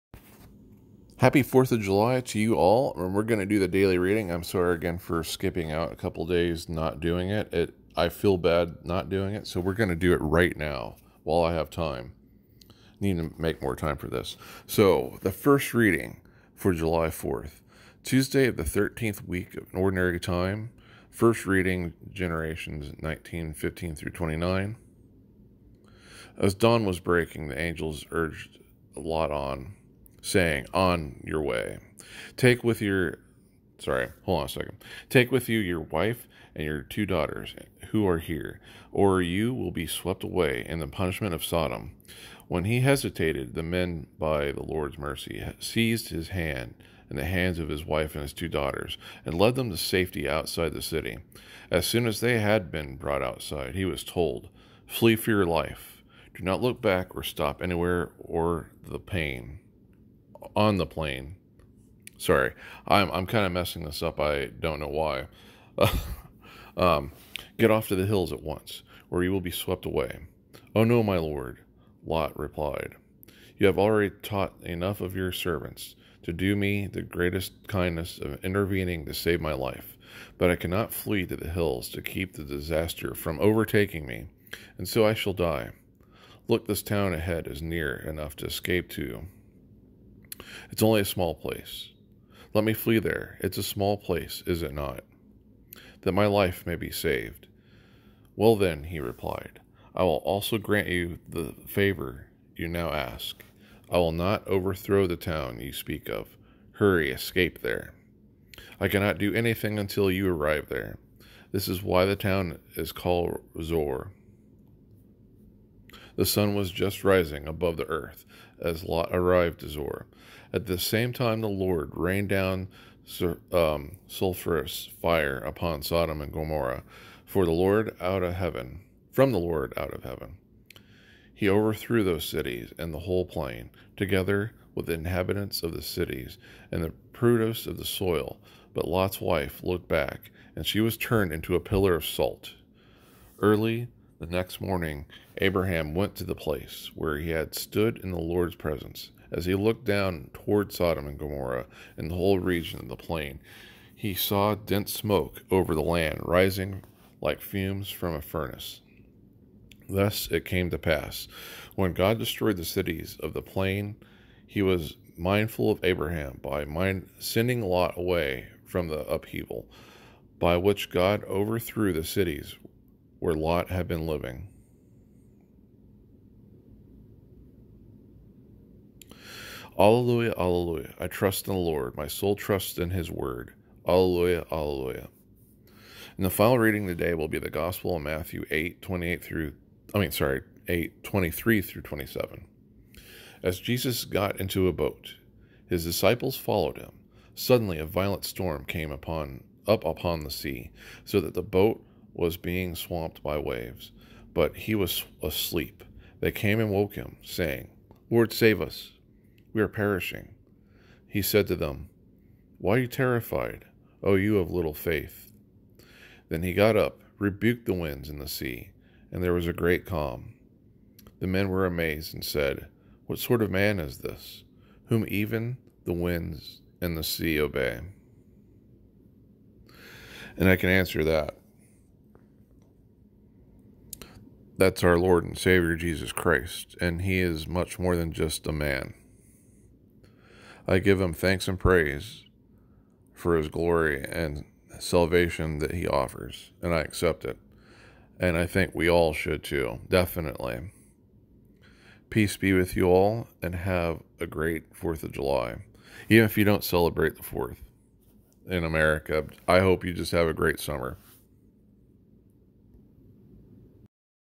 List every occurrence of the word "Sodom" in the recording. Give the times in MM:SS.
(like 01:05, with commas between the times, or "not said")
00:41, 02:05, 02:30.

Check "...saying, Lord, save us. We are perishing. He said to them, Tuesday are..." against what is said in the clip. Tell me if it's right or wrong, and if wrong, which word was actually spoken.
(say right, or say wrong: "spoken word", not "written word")
wrong: "Why", not "Tuesday".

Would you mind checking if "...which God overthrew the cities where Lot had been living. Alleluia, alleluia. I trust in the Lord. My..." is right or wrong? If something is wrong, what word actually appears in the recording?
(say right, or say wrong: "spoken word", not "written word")
right.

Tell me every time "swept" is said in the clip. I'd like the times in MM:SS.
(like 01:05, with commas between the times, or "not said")
00:39, 01:09.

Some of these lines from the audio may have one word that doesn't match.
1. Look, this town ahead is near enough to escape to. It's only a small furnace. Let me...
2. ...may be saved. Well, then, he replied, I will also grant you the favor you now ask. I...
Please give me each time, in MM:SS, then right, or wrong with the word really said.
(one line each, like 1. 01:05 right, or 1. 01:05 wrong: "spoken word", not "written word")
1. 01:26 wrong: "place", not "furnace"
2. 01:36 right.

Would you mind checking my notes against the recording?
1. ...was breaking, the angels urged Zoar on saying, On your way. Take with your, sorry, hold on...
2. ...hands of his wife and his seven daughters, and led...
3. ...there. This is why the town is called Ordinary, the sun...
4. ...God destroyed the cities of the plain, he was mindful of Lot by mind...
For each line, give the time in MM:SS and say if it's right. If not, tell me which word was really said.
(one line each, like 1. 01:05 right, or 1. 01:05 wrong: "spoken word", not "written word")
1. 00:26 wrong: "Lot", not "Zoar"
2. 00:47 wrong: "two", not "seven"
3. 01:50 wrong: "Zoar", not "Ordinary"
4. 02:41 wrong: "Abraham", not "Lot".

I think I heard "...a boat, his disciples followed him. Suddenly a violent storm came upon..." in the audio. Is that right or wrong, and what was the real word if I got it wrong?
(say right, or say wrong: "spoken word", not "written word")
right.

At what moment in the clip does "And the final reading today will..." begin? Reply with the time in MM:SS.
03:06.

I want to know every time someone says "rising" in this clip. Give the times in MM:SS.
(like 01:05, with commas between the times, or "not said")
01:57, 02:36.